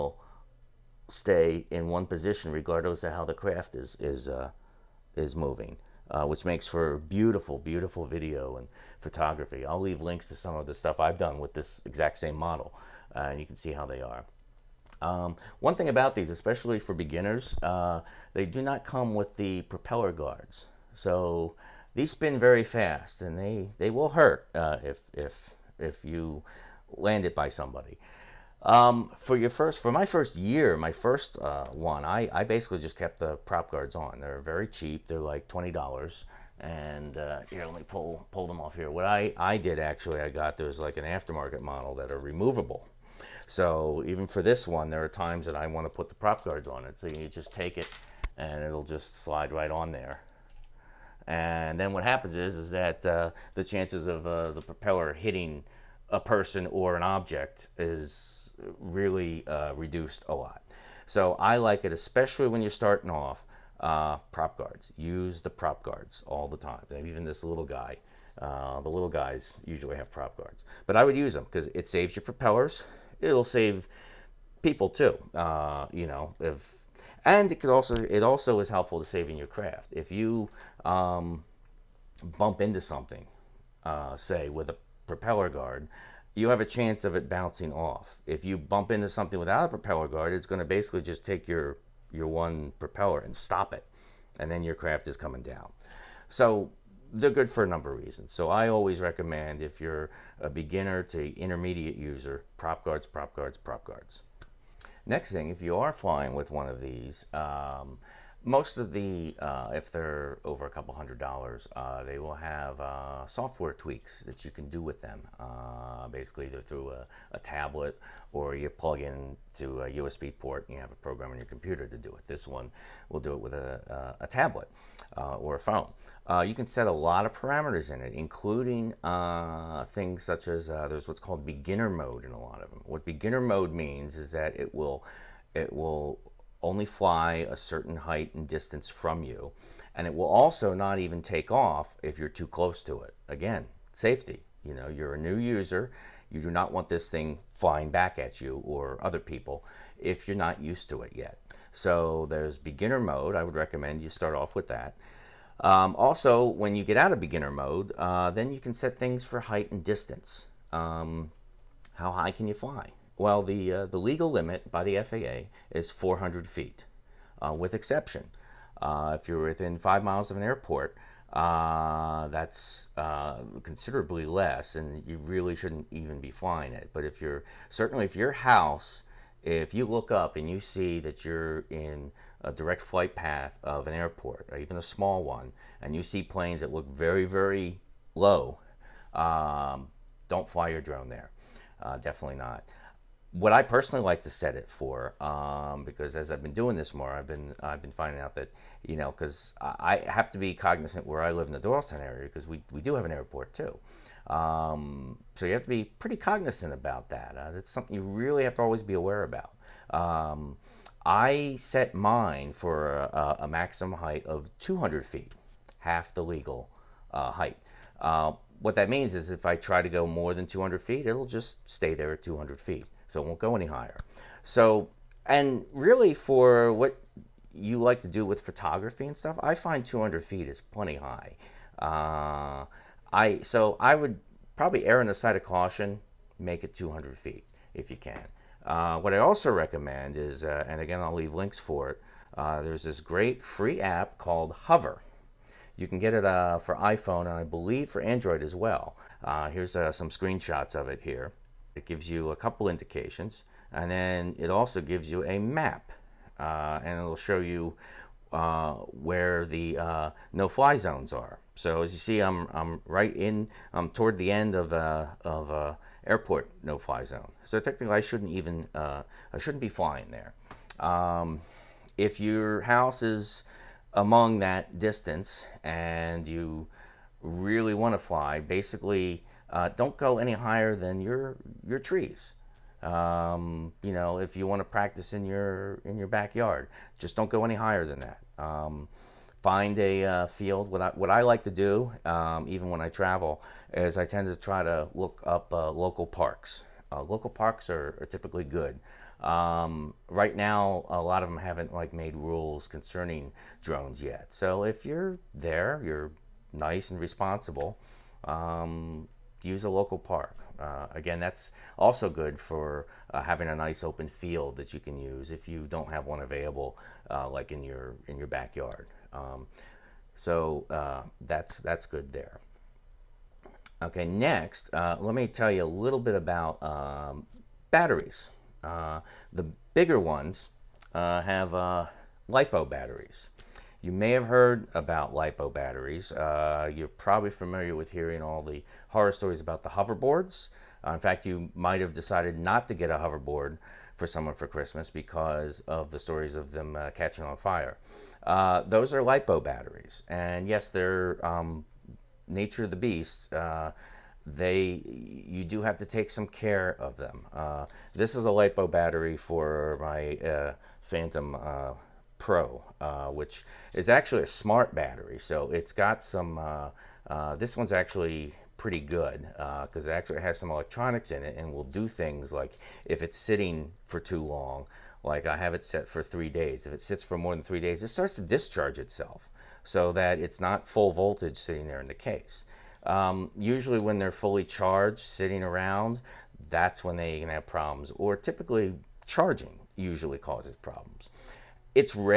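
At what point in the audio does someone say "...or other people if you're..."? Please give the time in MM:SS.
02:28.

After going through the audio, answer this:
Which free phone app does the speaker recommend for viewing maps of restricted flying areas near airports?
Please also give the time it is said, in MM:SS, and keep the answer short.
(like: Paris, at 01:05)
Hover, at 04:04.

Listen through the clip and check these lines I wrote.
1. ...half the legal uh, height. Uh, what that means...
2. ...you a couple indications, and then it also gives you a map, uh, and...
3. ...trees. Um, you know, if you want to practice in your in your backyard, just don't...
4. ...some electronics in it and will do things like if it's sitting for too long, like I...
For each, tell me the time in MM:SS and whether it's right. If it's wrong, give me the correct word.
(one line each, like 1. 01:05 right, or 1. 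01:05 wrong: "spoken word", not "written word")
1. 03:35 right
2. 04:12 right
3. 04:41 right
4. 06:10 right.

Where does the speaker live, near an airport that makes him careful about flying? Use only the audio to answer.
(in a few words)
Doylestown.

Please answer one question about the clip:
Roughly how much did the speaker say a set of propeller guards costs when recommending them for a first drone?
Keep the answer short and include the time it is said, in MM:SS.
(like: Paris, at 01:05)
$20, at 00:35.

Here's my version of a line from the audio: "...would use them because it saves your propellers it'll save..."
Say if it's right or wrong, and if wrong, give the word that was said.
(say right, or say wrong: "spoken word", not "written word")
right.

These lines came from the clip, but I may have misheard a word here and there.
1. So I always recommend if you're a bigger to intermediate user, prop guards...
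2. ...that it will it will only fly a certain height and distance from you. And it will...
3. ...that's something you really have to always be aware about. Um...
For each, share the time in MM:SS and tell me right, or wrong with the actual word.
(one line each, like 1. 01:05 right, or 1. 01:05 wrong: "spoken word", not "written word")
1. 01:38 wrong: "beginner", not "bigger"
2. 02:14 right
3. 03:27 right.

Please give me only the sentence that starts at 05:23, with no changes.
Okay, next, uh, let me tell you a little bit about um, batteries.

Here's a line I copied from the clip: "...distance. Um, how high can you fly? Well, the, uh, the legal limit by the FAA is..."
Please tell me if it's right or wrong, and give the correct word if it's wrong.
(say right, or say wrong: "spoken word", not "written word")
right.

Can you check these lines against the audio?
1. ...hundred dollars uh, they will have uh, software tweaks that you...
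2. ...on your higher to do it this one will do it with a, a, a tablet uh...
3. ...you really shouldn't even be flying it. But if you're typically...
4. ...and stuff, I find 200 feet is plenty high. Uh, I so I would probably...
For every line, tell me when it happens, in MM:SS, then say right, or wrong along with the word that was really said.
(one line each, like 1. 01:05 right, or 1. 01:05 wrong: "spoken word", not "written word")
1. 01:50 right
2. 02:01 wrong: "computer", not "higher"
3. 02:55 wrong: "certainly", not "typically"
4. 03:49 right.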